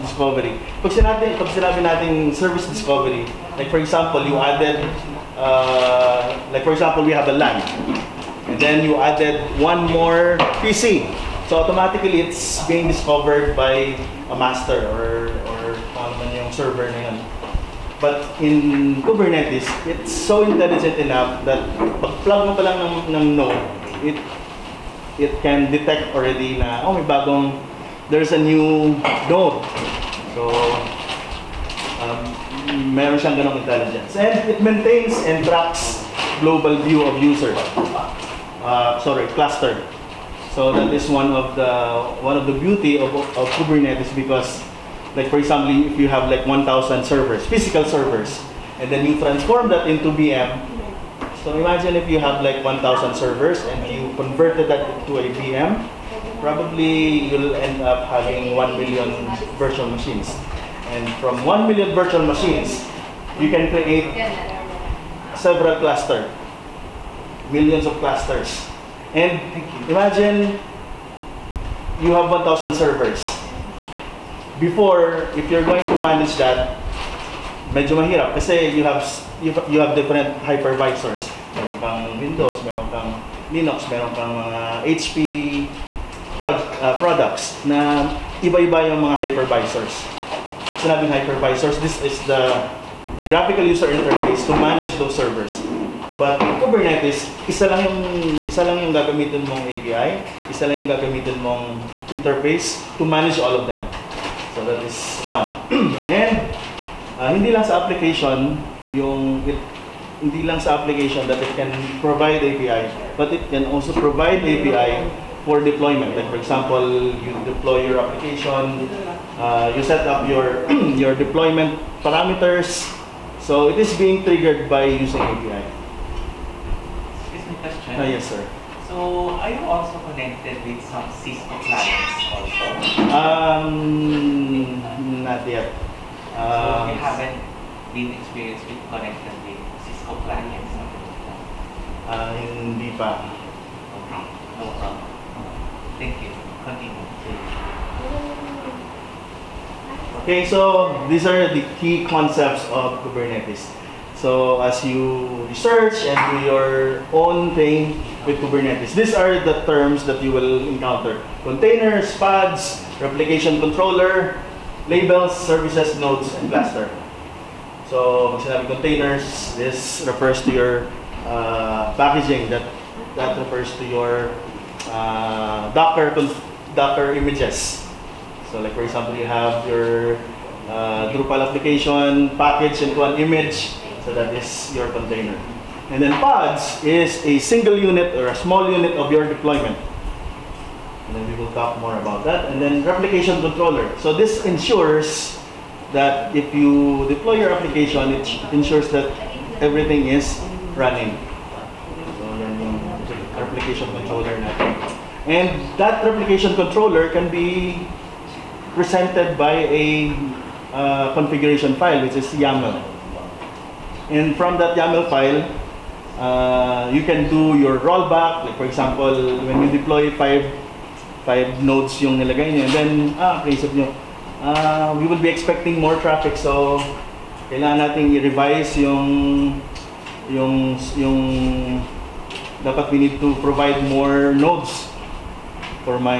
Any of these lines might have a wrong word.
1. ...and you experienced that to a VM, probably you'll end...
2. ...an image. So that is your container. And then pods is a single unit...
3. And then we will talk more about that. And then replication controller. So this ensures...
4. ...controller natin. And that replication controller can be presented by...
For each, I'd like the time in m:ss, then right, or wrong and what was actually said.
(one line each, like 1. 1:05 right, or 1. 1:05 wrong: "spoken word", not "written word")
1. 0:53 wrong: "converted", not "experienced"
2. 3:03 right
3. 3:11 right
4. 3:23 right.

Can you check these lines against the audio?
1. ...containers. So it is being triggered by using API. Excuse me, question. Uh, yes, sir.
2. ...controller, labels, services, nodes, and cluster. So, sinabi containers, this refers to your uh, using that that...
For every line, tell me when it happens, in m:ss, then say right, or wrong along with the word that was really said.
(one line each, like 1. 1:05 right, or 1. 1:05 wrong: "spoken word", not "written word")
1. 2:02 wrong: "parameters", not "containers"
2. 2:43 wrong: "packaging", not "using".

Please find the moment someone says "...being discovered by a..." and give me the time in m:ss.
0:12.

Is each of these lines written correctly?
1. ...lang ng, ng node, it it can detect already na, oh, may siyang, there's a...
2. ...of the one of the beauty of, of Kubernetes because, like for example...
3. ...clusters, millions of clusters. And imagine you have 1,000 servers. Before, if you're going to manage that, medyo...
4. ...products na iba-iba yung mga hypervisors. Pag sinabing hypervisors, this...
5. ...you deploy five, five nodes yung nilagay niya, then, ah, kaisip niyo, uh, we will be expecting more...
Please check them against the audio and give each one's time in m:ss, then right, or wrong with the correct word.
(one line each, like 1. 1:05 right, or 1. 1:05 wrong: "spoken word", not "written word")
1. 0:22 wrong: "bagong", not "siyang"
2. 0:41 right
3. 1:05 right
4. 1:27 right
5. 3:39 right.